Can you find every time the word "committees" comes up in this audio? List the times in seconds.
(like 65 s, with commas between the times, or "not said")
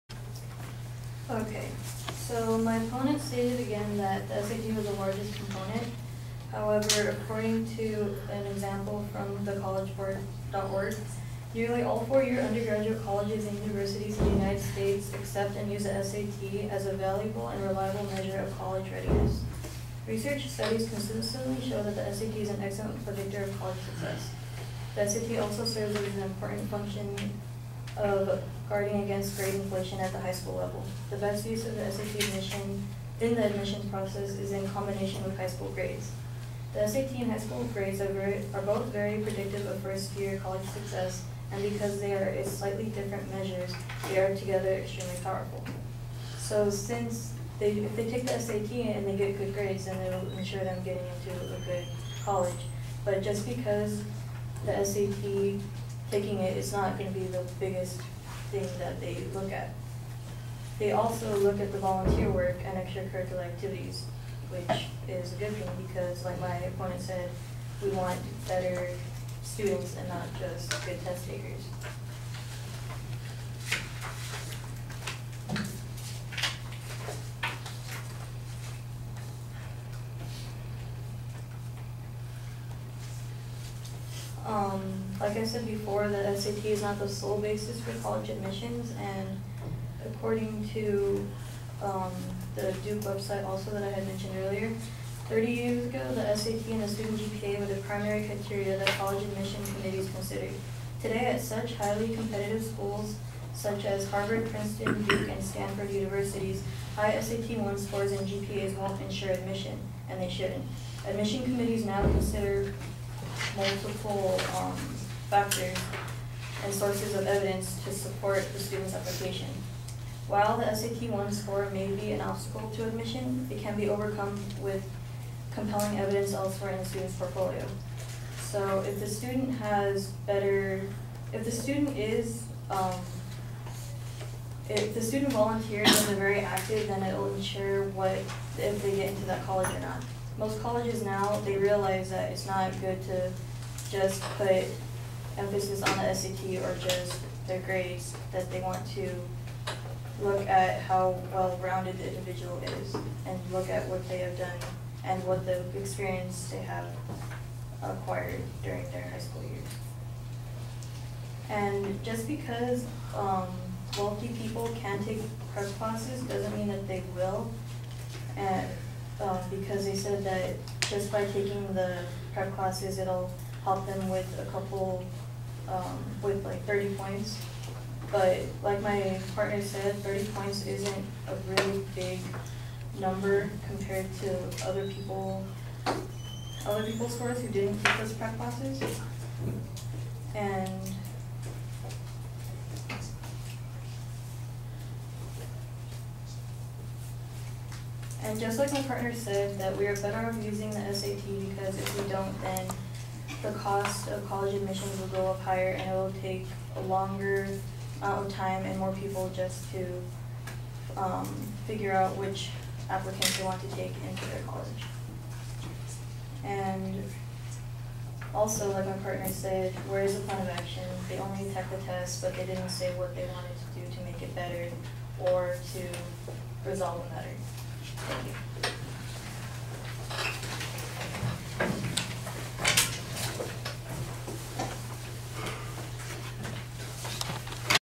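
99 s, 111 s.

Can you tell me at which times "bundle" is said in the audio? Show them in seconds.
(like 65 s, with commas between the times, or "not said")
not said.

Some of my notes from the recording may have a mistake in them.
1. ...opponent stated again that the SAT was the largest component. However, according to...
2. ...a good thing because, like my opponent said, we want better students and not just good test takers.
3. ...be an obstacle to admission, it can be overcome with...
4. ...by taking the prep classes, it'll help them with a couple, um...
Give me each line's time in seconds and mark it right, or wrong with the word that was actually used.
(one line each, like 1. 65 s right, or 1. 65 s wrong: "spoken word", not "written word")
1. 2 s right
2. 65 s right
3. 121 s right
4. 171 s right.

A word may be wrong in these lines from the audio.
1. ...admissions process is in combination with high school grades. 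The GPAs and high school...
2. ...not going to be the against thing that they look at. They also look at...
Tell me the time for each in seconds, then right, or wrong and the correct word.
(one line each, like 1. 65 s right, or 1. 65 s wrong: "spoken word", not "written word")
1. 33 s wrong: "SAT", not "GPAs"
2. 56 s wrong: "biggest", not "against".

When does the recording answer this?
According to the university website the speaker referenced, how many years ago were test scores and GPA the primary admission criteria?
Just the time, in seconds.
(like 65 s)
95 s.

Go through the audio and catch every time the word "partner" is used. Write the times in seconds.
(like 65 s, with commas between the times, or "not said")
179 s, 198 s, 218 s.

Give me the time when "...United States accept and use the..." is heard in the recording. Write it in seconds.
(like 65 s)
14 s.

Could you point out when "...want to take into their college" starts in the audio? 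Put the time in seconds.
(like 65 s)
213 s.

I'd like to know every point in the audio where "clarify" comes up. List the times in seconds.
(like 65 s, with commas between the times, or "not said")
not said.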